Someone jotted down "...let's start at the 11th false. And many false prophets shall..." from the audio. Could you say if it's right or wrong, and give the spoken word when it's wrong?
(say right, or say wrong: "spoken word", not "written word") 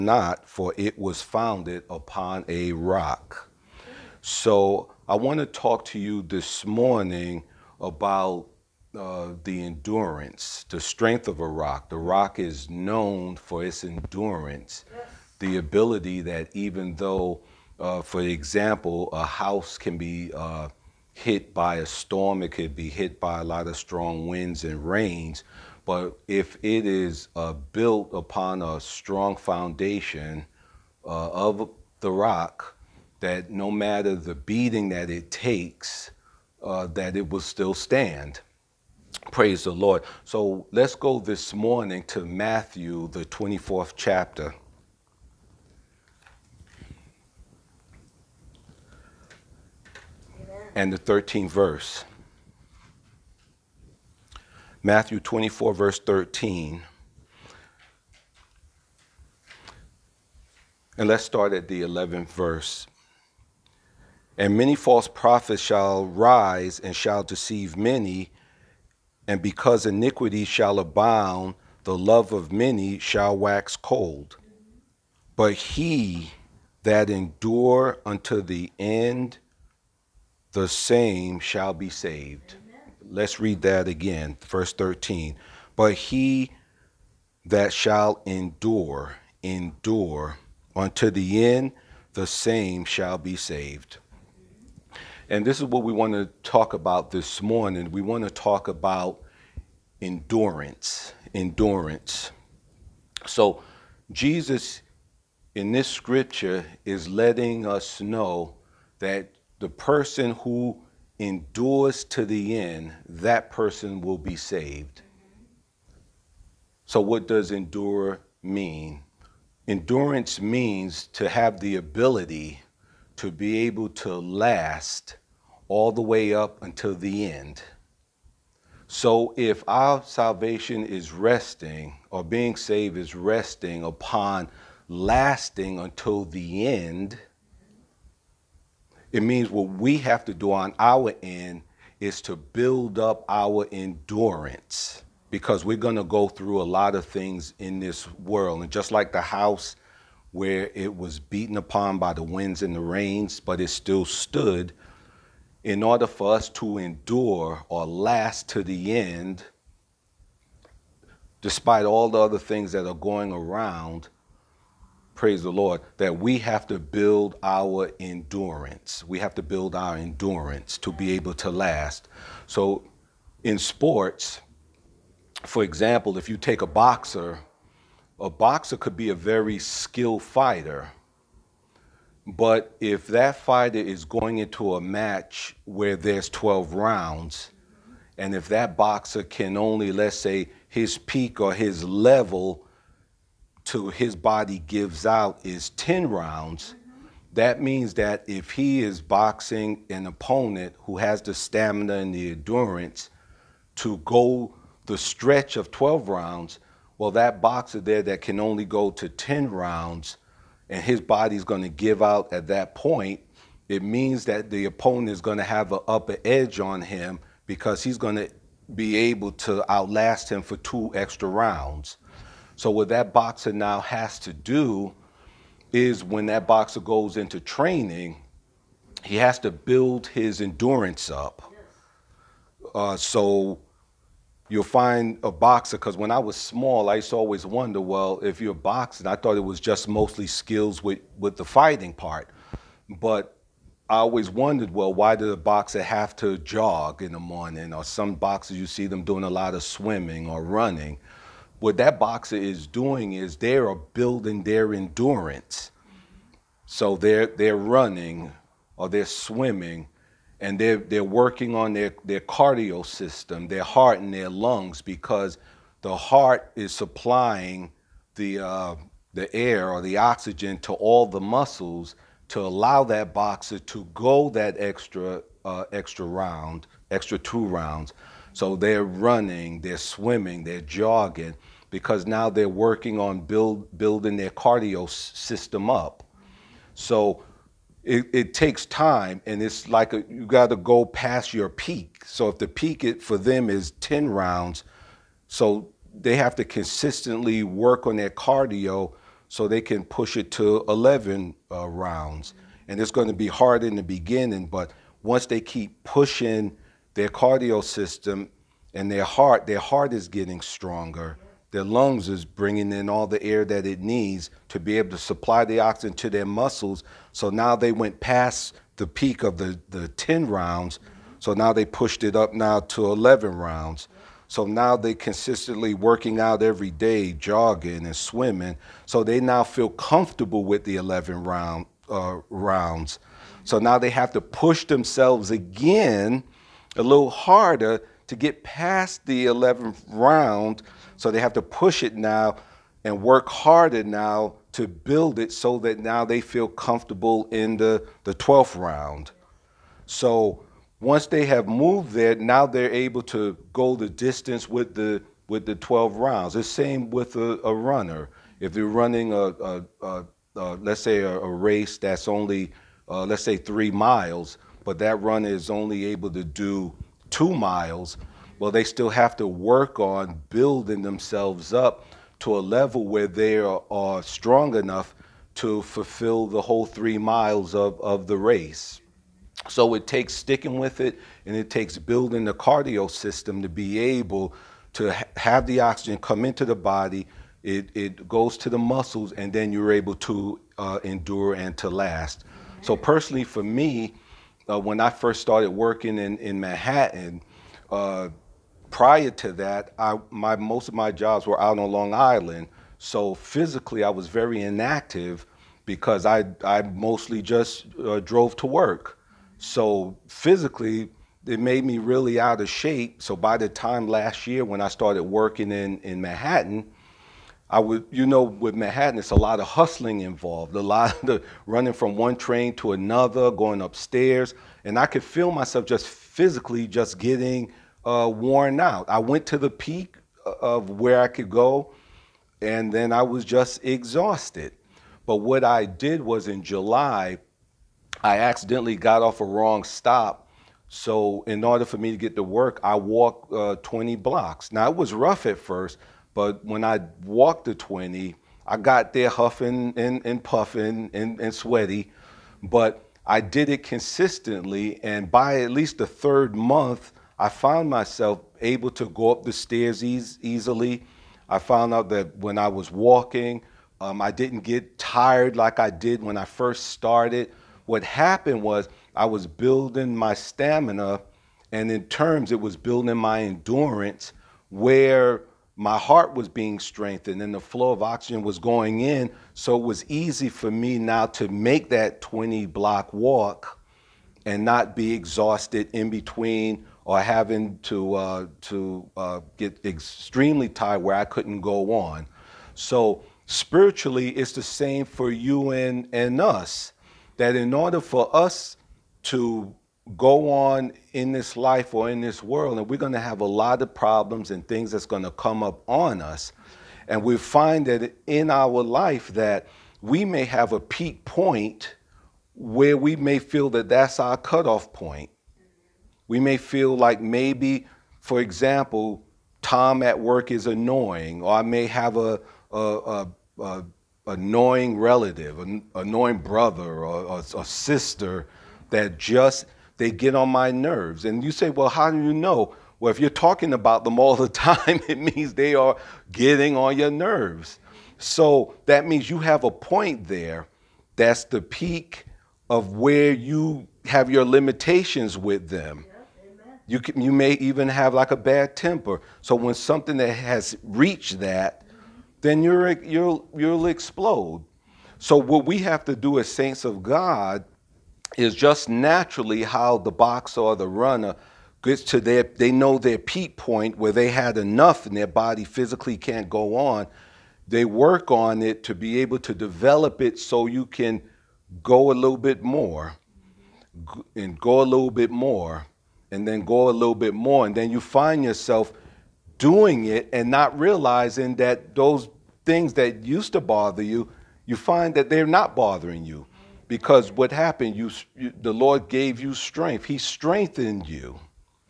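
wrong: "verse", not "false".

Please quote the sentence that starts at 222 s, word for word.
So, what that boxer now has to do is when that boxer goes into training, he has to build his endurance up.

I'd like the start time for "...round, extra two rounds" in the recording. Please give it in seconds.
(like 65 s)
276 s.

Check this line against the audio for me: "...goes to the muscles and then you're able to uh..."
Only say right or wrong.
right.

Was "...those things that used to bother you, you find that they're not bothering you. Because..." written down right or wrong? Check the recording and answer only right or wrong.
right.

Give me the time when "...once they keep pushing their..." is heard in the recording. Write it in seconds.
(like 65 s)
305 s.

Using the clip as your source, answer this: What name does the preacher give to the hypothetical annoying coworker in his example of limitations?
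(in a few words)
Tom.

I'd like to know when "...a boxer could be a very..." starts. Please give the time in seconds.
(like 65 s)
178 s.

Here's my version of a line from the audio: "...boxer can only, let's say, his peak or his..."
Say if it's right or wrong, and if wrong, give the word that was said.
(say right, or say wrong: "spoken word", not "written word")
right.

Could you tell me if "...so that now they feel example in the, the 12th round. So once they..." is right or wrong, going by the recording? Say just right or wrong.
wrong.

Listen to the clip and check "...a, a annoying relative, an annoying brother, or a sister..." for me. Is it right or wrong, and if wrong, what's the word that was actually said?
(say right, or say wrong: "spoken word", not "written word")
right.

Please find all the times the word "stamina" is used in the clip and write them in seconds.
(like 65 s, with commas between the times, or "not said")
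201 s, 470 s.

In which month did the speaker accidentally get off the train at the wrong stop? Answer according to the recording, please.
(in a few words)
July.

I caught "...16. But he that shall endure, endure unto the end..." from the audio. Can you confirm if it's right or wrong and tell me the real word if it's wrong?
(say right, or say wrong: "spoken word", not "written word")
wrong: "13", not "16".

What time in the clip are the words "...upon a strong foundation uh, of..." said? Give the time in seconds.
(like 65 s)
28 s.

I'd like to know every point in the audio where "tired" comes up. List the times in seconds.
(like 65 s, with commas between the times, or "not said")
464 s, 490 s.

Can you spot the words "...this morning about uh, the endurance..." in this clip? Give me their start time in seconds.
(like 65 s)
6 s.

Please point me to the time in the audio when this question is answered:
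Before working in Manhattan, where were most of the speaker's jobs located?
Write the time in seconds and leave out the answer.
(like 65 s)
401 s.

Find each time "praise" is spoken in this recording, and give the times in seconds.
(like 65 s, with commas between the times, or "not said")
39 s, 165 s.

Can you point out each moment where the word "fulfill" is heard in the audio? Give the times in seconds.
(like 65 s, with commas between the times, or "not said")
375 s.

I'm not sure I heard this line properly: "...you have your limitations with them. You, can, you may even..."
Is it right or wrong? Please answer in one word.
right.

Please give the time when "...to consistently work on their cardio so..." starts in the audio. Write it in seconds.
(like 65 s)
296 s.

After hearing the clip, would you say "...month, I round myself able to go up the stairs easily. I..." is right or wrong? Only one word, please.
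wrong.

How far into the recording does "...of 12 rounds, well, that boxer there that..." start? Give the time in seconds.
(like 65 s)
205 s.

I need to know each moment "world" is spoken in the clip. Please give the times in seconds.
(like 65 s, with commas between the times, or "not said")
148 s, 502 s.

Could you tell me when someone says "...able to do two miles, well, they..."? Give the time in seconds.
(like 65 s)
365 s.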